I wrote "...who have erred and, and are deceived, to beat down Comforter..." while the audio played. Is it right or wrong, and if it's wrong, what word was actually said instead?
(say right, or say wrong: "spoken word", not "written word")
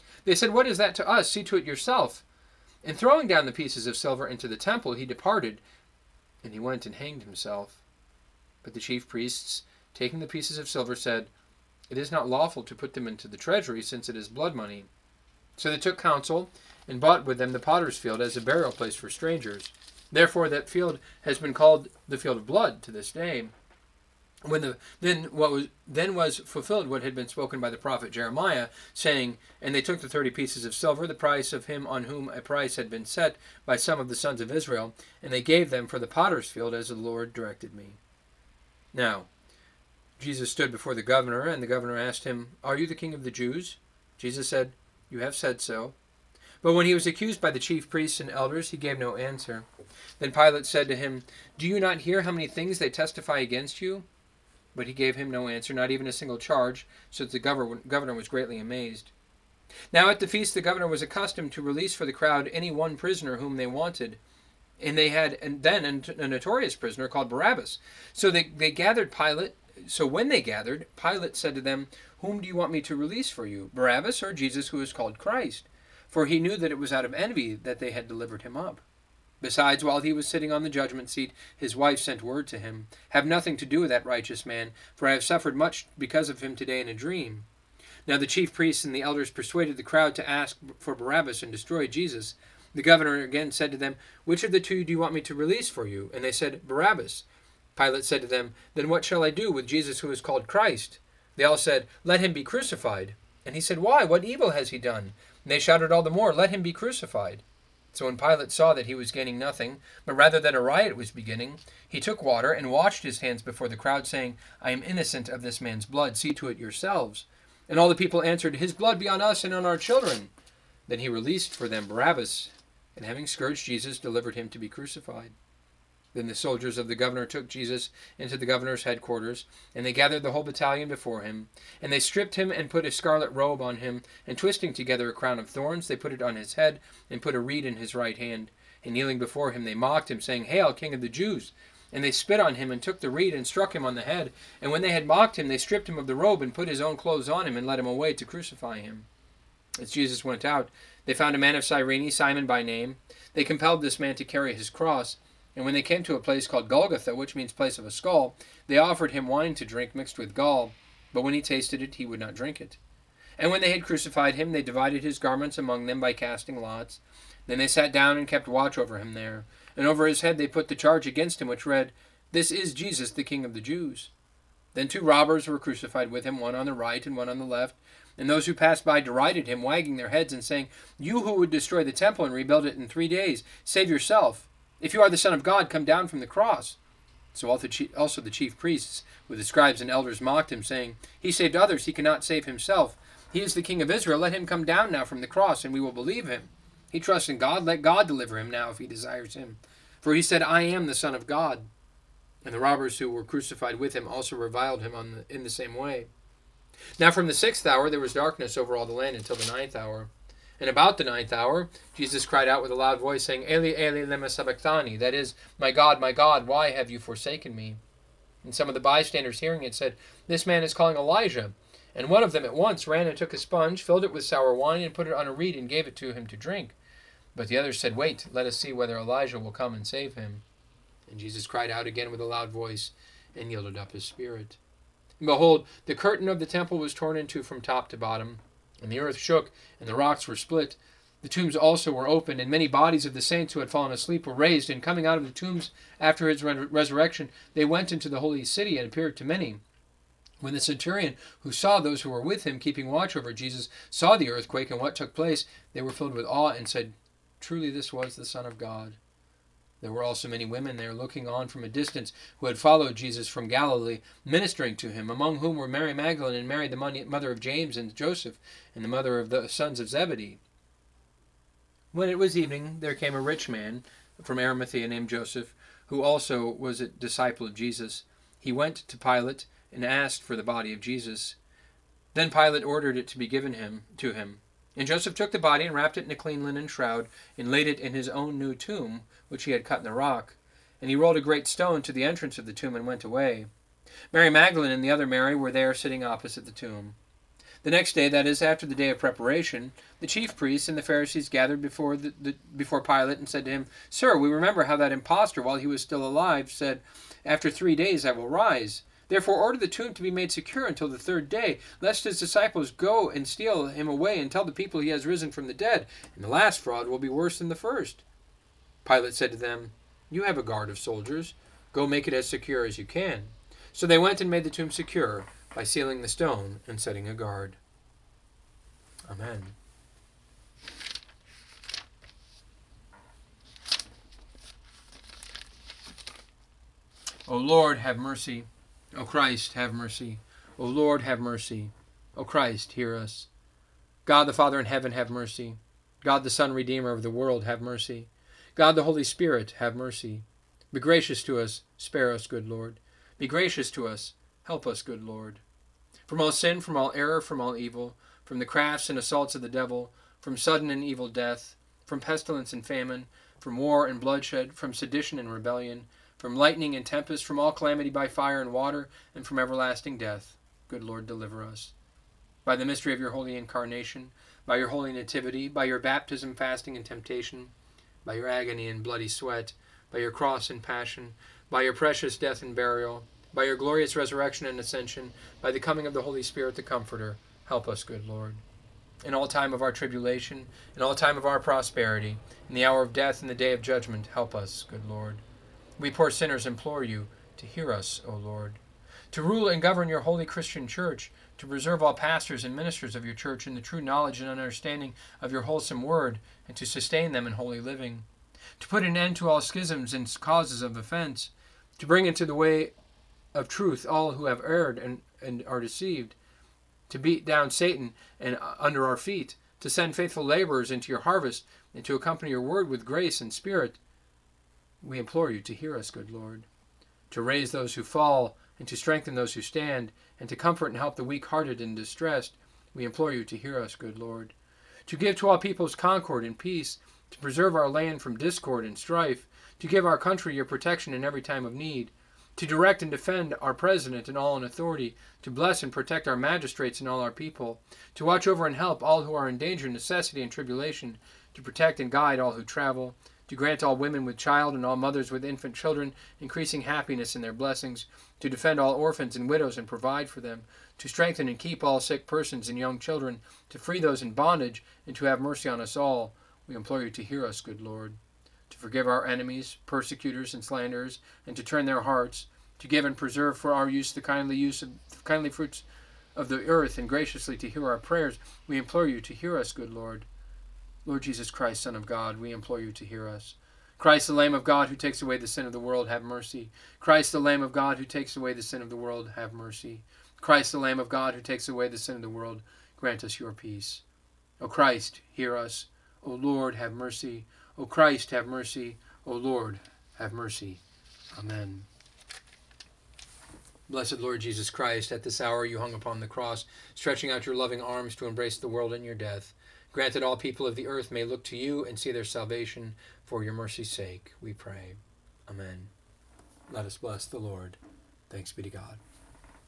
wrong: "Satan", not "Comforter".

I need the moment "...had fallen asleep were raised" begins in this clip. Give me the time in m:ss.
4:03.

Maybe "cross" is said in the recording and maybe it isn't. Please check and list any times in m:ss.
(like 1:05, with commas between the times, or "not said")
2:34, 3:06, 3:15, 6:20, 8:26.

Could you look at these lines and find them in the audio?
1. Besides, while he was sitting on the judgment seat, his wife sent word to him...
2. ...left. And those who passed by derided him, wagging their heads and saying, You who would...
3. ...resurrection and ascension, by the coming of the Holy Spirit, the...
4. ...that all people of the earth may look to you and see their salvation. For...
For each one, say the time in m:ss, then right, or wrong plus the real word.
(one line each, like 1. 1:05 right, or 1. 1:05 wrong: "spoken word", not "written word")
1. 1:19 right
2. 2:57 right
3. 6:23 right
4. 8:29 right.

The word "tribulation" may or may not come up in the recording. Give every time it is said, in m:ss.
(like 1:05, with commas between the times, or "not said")
6:29, 7:30.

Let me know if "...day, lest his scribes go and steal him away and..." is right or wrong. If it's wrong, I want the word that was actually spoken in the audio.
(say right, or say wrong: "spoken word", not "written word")
wrong: "disciples", not "scribes".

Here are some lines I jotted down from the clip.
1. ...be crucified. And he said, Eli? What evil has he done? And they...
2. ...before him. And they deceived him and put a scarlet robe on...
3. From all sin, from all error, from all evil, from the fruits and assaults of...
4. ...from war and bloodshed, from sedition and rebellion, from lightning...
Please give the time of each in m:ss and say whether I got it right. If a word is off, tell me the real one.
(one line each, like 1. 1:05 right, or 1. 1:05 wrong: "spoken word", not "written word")
1. 1:42 wrong: "Why", not "Eli"
2. 2:10 wrong: "stripped", not "deceived"
3. 5:56 wrong: "crafts", not "fruits"
4. 6:03 right.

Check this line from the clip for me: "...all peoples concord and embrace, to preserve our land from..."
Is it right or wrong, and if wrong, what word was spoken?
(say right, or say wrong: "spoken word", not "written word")
wrong: "peace", not "embrace".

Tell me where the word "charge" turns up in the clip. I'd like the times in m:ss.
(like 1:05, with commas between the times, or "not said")
0:56, 2:50.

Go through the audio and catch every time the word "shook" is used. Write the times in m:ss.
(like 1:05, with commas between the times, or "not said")
3:59.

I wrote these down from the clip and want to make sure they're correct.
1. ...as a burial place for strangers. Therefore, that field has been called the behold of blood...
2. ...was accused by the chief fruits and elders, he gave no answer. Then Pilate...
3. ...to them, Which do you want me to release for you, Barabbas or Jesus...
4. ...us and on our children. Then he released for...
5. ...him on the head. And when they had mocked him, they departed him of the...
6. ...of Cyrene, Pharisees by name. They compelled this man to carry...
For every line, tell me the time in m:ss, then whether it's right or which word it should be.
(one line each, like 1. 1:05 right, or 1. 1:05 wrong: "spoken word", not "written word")
1. 0:18 wrong: "field", not "behold"
2. 0:46 wrong: "priests", not "fruits"
3. 1:11 wrong: "Whom", not "Which"
4. 1:59 right
5. 2:23 wrong: "stripped", not "departed"
6. 2:31 wrong: "Simon", not "Pharisees".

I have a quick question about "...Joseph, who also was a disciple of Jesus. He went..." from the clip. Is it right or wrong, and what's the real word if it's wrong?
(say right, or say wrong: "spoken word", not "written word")
right.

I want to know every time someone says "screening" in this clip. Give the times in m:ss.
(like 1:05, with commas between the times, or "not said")
not said.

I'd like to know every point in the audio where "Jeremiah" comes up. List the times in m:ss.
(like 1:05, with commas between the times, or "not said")
0:28.